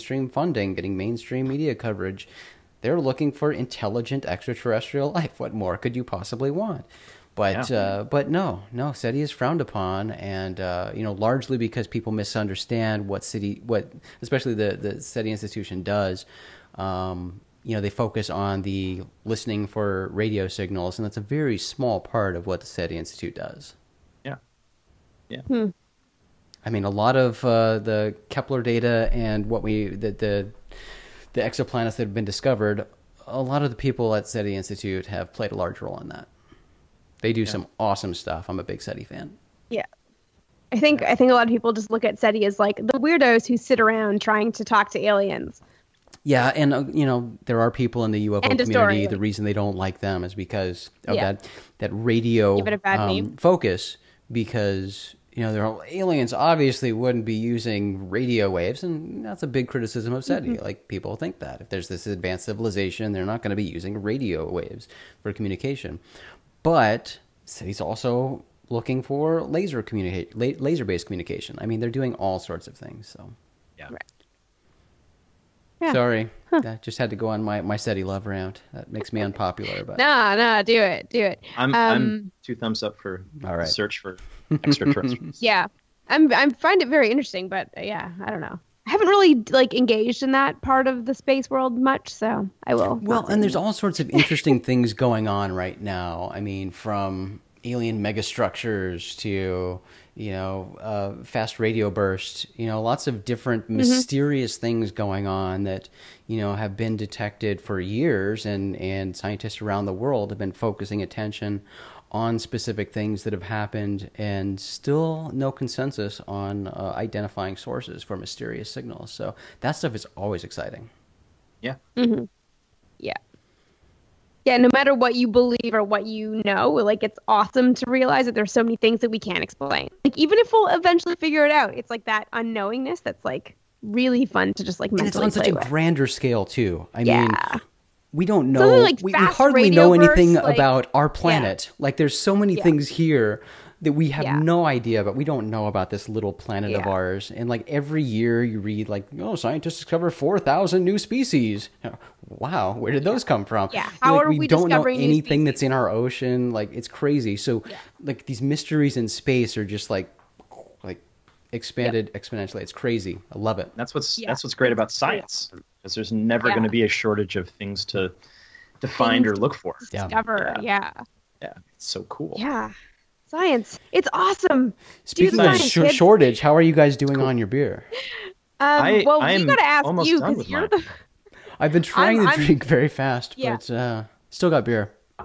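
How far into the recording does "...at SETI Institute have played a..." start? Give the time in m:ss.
0:34.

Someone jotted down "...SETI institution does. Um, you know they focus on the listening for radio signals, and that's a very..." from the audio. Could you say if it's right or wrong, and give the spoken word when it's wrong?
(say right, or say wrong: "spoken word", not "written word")
right.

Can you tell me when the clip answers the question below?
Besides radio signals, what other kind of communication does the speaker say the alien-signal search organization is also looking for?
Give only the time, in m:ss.
1:10.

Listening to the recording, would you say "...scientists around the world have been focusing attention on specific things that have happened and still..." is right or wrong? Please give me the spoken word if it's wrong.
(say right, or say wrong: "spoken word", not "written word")
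right.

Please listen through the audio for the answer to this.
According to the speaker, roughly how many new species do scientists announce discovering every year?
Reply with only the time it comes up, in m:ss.
2:30.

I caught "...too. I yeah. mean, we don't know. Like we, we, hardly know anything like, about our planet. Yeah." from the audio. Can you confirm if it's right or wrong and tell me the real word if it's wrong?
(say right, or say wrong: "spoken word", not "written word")
right.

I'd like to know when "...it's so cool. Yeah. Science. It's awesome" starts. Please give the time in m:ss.
2:51.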